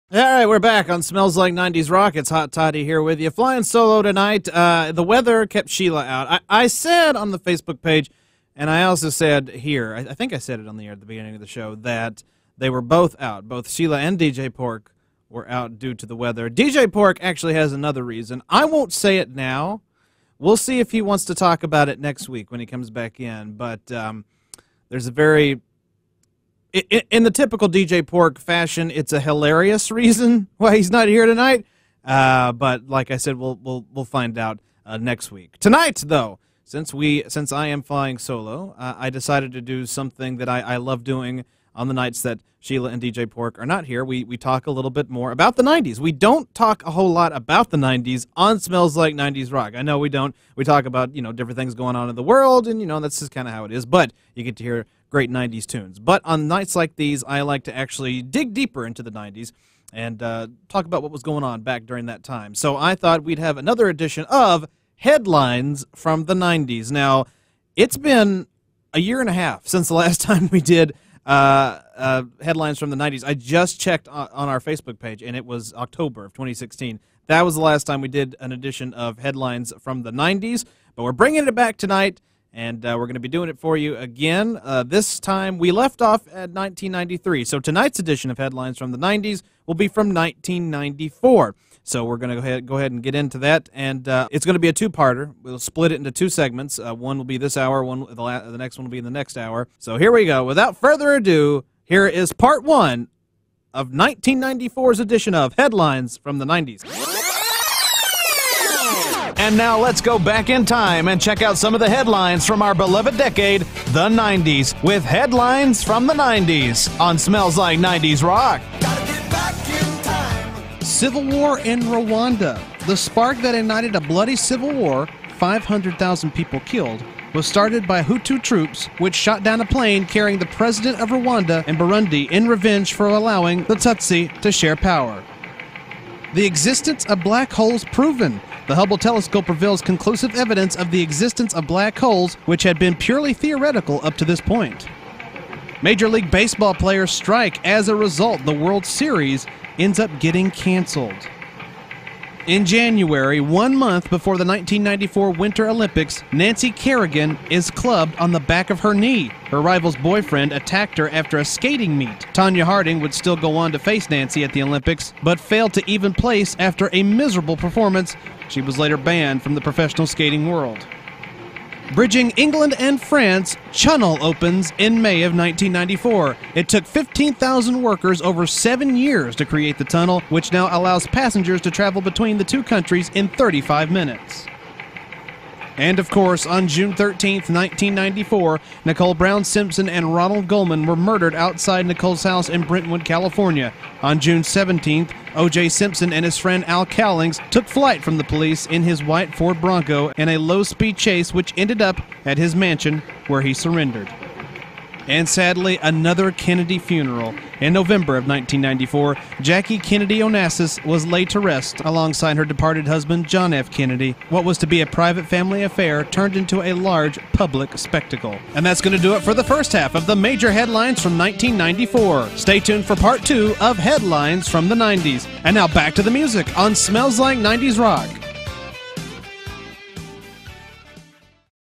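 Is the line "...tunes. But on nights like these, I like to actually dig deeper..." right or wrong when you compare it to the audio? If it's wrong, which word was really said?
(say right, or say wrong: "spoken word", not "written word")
right.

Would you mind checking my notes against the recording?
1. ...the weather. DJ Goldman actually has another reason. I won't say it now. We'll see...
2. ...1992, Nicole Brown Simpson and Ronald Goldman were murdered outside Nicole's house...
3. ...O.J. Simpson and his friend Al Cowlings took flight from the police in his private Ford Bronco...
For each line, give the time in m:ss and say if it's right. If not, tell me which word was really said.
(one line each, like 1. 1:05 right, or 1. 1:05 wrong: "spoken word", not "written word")
1. 0:16 wrong: "Pork", not "Goldman"
2. 3:07 wrong: "1994", not "1992"
3. 3:15 wrong: "white", not "private".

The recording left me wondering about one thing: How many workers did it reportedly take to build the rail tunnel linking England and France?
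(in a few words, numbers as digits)
15,000.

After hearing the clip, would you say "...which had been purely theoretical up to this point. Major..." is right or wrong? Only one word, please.
right.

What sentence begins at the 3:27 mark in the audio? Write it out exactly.
In November of 1994, Jackie Kennedy Onassis was laid to rest alongside her departed husband, John F.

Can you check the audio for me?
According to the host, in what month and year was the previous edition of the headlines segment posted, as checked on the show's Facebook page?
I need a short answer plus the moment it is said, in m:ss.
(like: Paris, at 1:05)
October 2016, at 1:15.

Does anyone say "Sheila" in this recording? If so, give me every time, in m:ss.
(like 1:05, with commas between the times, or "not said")
0:05, 0:13, 0:42.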